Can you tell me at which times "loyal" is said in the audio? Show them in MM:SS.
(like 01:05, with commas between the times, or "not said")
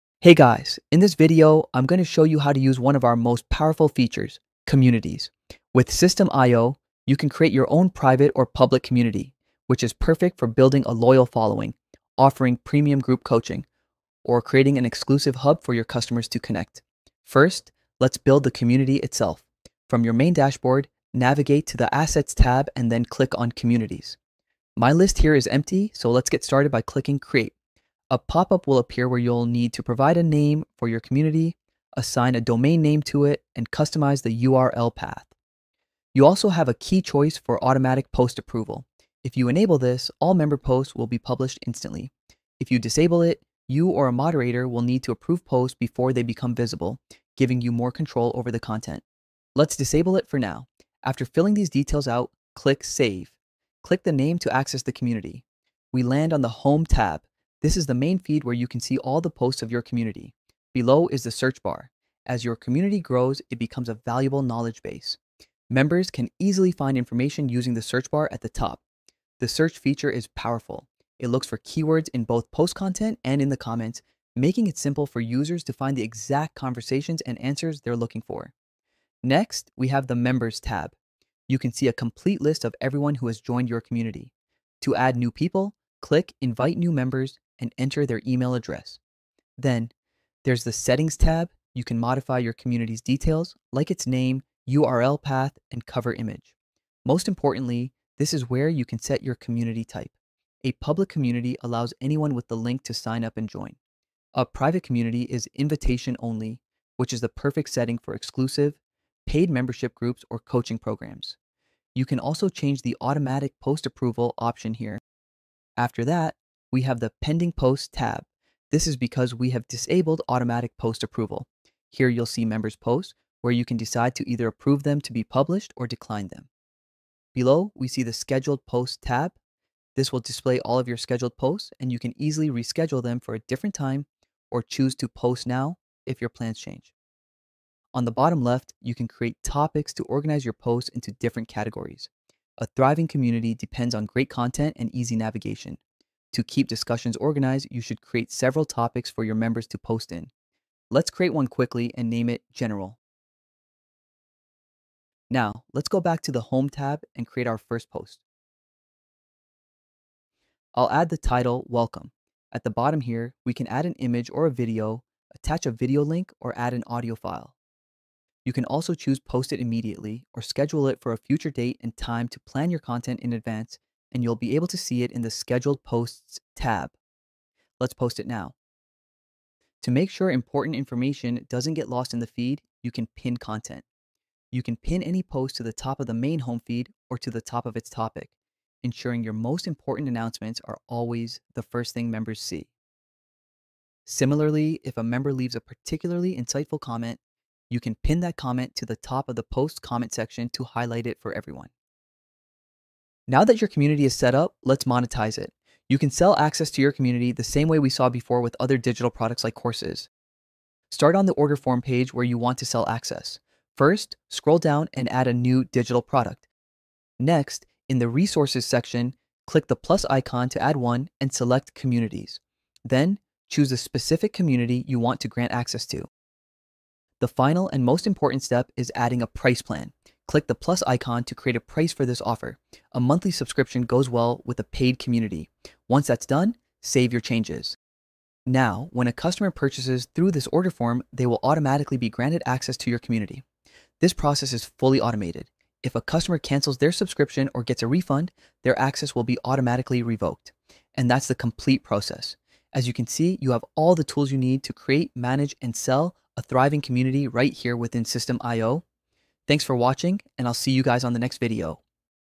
00:10.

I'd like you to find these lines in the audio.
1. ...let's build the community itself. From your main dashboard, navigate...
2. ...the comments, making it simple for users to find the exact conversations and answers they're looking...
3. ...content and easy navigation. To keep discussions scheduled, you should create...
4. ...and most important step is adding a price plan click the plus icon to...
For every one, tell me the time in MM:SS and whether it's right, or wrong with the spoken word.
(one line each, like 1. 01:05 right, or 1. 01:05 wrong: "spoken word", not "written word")
1. 00:17 right
2. 01:13 right
3. 02:24 wrong: "organized", not "scheduled"
4. 03:47 right.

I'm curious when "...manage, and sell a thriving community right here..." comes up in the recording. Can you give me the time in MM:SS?
04:15.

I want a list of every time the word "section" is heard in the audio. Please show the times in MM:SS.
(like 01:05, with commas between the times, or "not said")
03:20, 03:38.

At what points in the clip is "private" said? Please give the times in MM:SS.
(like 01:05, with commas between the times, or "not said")
00:07, 01:44.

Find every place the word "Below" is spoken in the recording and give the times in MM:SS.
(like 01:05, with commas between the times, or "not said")
01:00, 02:07.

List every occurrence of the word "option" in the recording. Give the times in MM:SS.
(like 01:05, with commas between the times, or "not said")
01:54.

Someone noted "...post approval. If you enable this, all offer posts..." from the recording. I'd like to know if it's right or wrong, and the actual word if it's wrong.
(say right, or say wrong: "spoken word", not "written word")
wrong: "member", not "offer".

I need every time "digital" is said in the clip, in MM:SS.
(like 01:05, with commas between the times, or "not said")
03:28, 03:35.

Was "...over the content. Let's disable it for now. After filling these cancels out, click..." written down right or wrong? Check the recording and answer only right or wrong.
wrong.